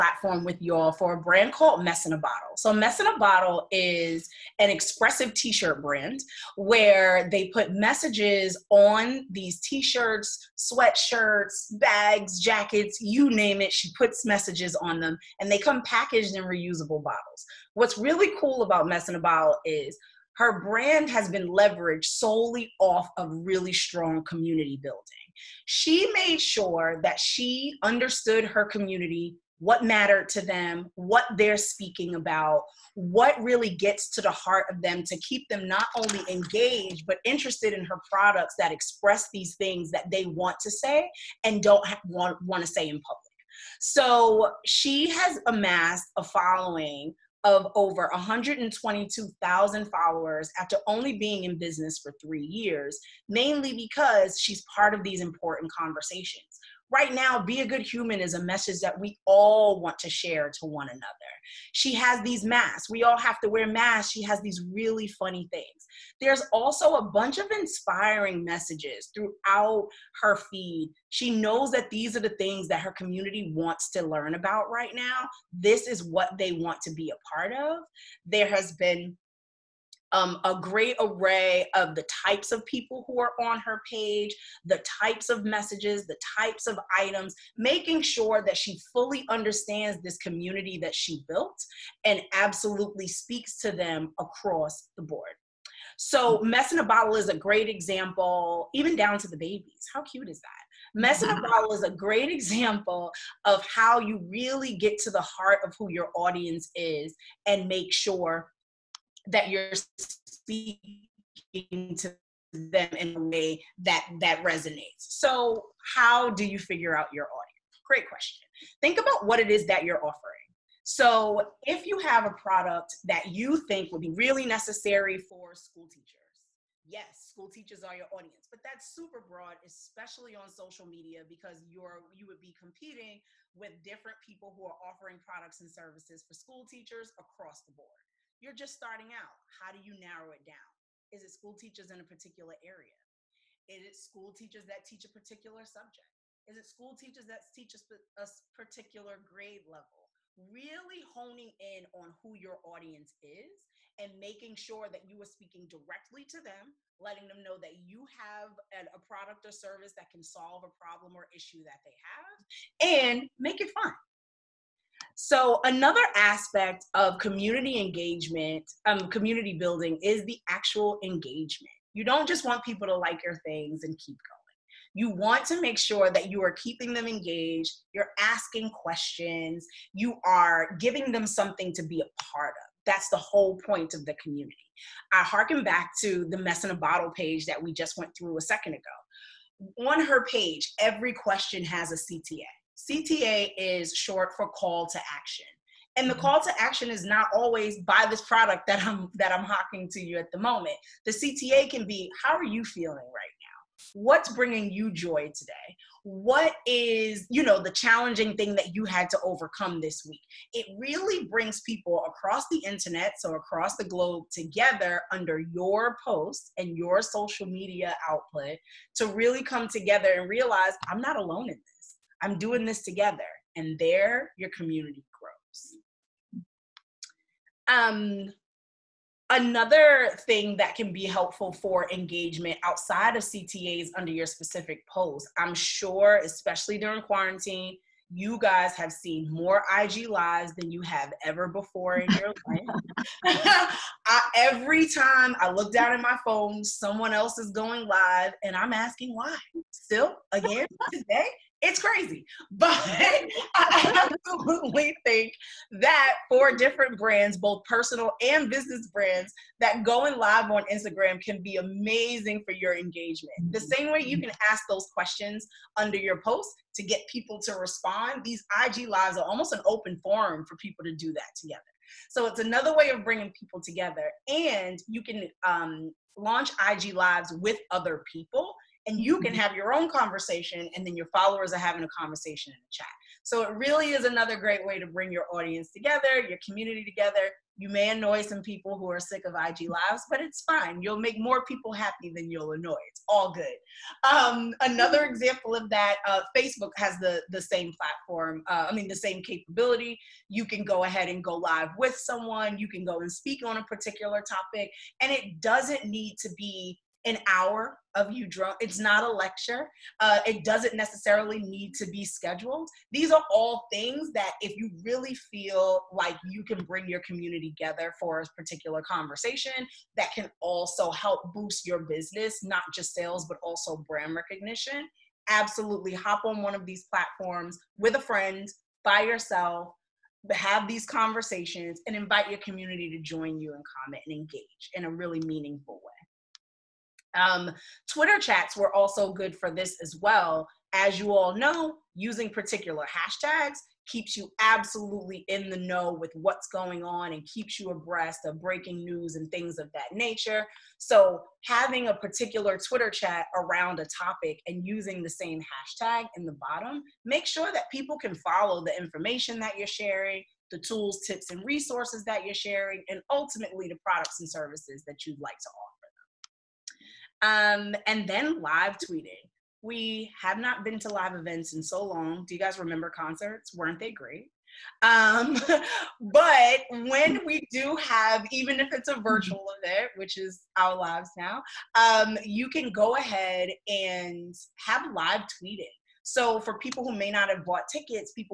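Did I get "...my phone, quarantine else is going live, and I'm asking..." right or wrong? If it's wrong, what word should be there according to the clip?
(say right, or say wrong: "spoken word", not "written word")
wrong: "someone", not "quarantine".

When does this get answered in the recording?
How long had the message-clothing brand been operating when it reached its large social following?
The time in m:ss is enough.
0:52.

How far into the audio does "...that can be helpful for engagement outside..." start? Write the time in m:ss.
3:50.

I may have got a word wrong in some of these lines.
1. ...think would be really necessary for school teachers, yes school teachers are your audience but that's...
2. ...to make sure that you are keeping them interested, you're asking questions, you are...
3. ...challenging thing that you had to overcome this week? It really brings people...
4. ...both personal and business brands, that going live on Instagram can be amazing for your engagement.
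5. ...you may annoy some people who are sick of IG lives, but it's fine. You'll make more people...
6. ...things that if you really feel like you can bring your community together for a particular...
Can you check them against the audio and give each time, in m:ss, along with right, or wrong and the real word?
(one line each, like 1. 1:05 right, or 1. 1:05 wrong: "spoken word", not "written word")
1. 2:03 right
2. 2:55 wrong: "engaged", not "interested"
3. 3:27 right
4. 4:17 right
5. 4:47 right
6. 5:13 right.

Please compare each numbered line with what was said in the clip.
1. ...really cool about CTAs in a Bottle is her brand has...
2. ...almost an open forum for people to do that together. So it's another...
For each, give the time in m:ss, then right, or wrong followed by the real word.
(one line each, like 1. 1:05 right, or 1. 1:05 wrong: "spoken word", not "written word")
1. 0:17 wrong: "Mess", not "CTAs"
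2. 4:29 right.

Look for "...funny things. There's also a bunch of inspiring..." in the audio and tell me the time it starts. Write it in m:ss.
1:05.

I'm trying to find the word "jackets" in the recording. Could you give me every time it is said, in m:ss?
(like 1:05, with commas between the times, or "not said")
0:12.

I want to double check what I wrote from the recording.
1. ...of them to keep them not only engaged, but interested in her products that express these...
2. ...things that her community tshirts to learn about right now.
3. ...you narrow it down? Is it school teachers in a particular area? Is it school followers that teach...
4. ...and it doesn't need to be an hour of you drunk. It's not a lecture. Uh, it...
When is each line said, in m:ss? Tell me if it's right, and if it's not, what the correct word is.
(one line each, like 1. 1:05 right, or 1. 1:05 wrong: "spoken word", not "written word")
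1. 0:34 right
2. 1:12 wrong: "wants", not "tshirts"
3. 2:19 wrong: "teachers", not "followers"
4. 5:05 right.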